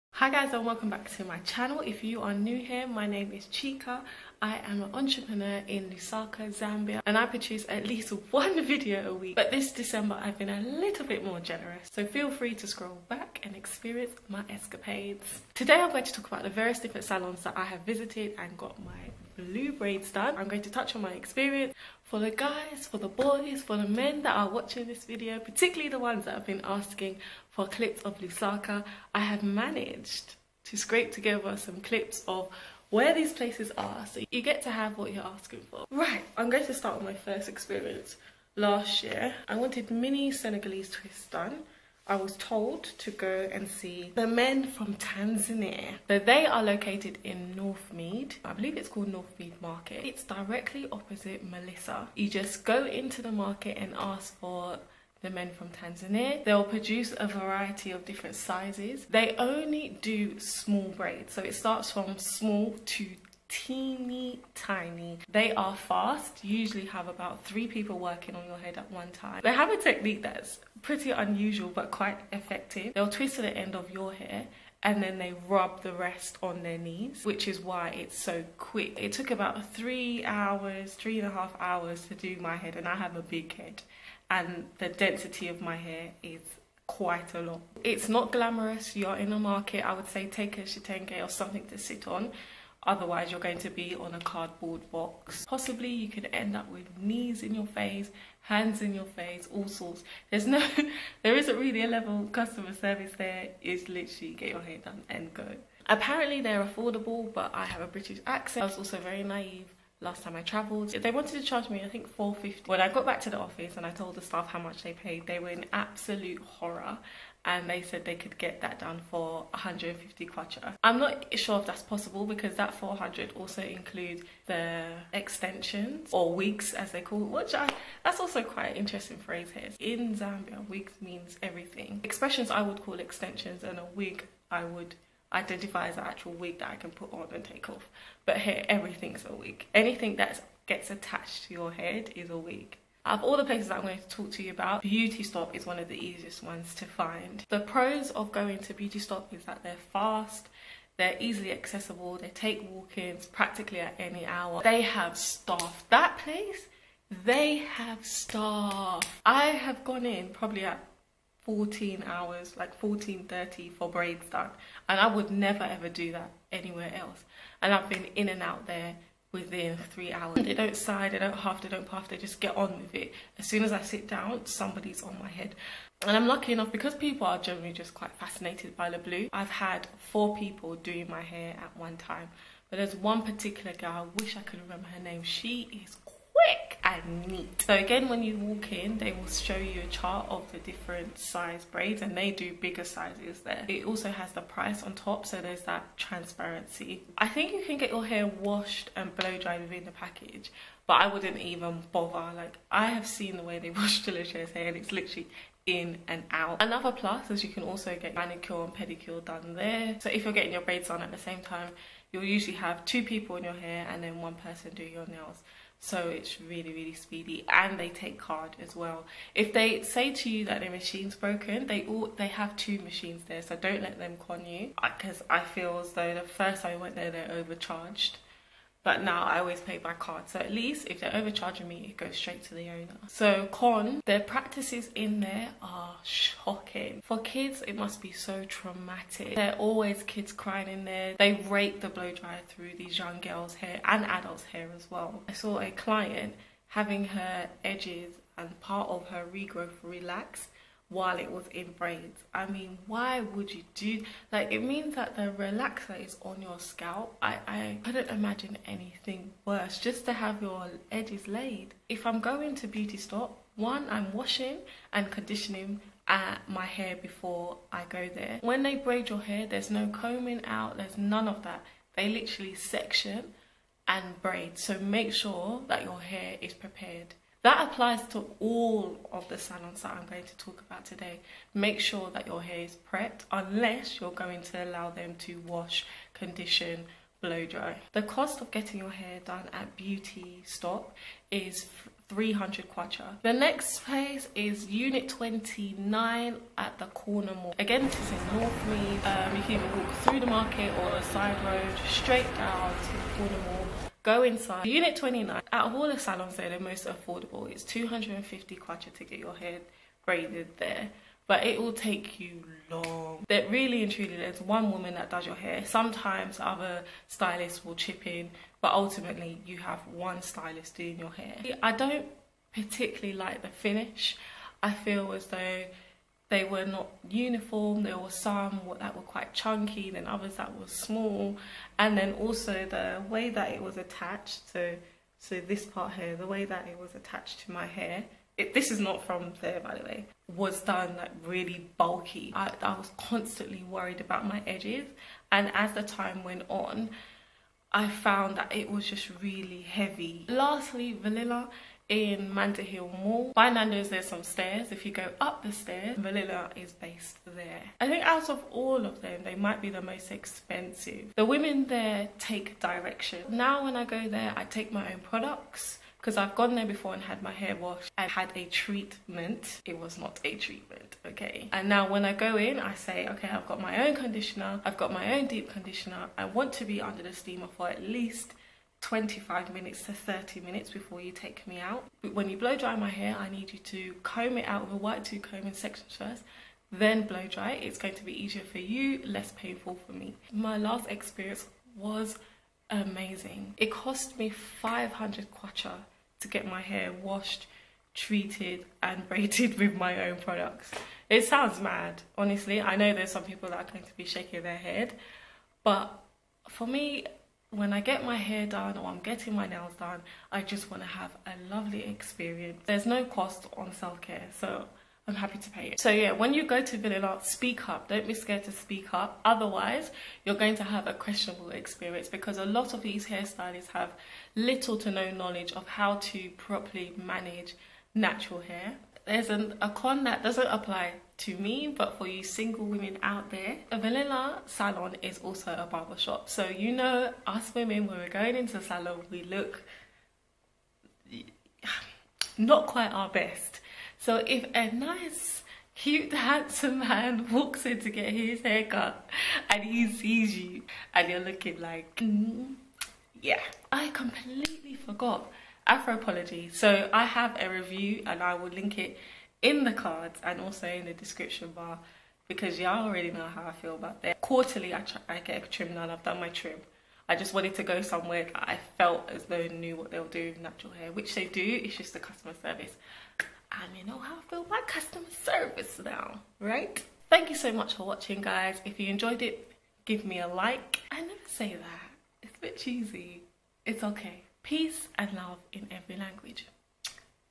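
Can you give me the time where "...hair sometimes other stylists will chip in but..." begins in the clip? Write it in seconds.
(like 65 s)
315 s.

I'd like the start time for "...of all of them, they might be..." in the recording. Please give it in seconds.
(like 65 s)
358 s.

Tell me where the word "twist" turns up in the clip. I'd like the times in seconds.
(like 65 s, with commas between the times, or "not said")
40 s, 73 s.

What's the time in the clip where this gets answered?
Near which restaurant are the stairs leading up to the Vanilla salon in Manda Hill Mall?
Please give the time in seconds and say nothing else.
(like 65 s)
353 s.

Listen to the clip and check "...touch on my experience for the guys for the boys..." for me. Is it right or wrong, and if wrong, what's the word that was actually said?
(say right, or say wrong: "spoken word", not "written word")
right.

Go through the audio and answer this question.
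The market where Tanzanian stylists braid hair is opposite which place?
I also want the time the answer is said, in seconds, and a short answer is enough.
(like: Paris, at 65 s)
Melissa, at 51 s.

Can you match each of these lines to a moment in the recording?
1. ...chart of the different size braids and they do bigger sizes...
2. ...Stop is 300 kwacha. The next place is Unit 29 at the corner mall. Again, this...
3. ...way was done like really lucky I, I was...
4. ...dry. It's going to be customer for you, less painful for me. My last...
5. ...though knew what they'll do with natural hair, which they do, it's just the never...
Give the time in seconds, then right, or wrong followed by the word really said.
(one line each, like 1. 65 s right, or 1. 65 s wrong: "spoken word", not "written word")
1. 189 s right
2. 290 s right
3. 339 s wrong: "bulky", not "lucky"
4. 387 s wrong: "easier", not "customer"
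5. 469 s wrong: "customer", not "never".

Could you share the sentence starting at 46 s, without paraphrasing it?
So they are located in North Mead.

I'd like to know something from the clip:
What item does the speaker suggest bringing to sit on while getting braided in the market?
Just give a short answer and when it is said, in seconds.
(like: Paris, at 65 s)
A chitenge, at 90 s.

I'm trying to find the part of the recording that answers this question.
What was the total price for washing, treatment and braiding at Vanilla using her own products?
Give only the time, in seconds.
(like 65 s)
394 s.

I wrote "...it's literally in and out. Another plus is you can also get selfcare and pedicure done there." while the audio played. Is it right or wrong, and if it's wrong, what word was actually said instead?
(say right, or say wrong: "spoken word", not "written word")
wrong: "manicure", not "selfcare".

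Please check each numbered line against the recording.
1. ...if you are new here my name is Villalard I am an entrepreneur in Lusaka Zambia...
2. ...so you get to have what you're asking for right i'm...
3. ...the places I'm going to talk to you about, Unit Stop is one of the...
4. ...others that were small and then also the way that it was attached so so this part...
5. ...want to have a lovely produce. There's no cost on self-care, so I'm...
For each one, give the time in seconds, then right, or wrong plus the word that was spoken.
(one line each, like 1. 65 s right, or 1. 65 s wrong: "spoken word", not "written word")
1. 1 s wrong: "Chika", not "Villalard"
2. 34 s right
3. 143 s wrong: "Beauty", not "Unit"
4. 330 s right
5. 410 s wrong: "experience", not "produce".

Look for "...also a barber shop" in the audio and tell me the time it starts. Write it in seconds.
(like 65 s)
435 s.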